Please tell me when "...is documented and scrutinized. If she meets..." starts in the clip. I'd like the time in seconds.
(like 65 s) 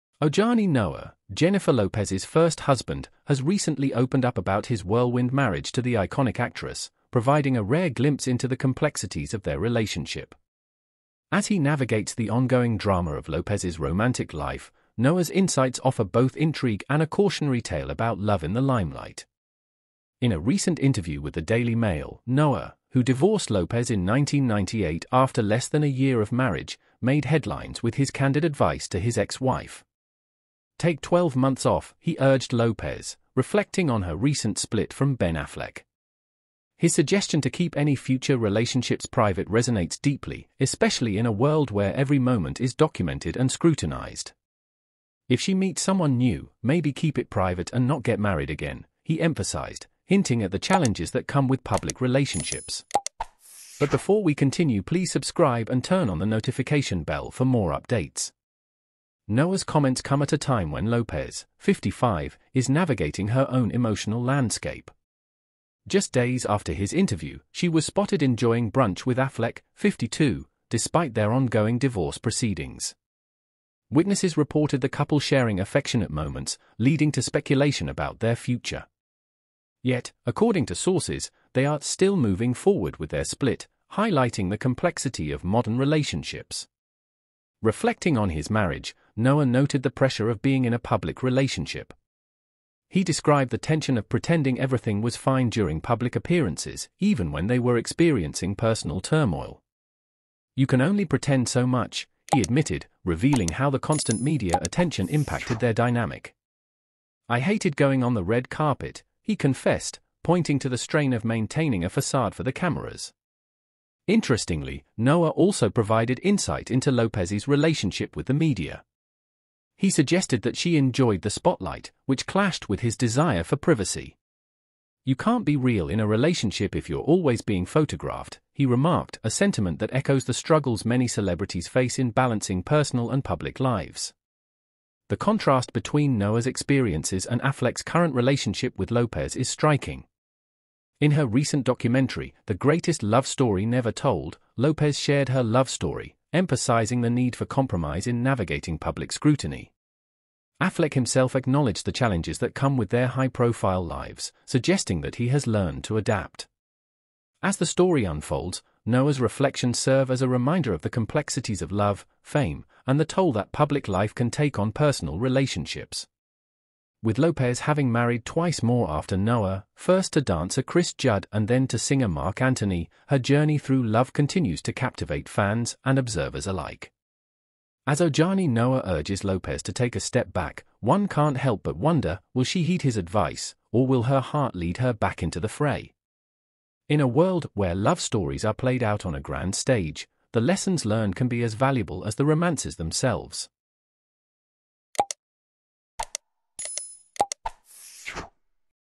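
42 s.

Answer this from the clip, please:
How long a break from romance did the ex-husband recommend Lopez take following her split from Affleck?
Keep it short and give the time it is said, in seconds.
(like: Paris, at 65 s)
12 months, at 31 s.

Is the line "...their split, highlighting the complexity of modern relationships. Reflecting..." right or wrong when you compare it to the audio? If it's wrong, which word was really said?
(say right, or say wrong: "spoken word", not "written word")
right.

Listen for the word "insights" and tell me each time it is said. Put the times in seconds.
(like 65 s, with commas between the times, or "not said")
15 s, 116 s.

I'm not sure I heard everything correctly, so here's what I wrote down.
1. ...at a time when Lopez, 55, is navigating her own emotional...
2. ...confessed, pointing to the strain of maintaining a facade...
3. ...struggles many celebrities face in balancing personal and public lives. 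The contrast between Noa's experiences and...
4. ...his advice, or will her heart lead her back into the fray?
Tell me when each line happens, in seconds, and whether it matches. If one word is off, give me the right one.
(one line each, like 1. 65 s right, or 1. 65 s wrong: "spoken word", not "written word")
1. 60 s right
2. 109 s right
3. 130 s right
4. 182 s right.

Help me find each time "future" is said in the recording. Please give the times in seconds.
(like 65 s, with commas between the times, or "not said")
37 s, 78 s.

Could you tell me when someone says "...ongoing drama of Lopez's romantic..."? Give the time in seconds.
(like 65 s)
12 s.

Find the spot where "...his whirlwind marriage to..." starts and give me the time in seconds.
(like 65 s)
4 s.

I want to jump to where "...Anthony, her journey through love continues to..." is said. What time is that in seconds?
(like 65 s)
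172 s.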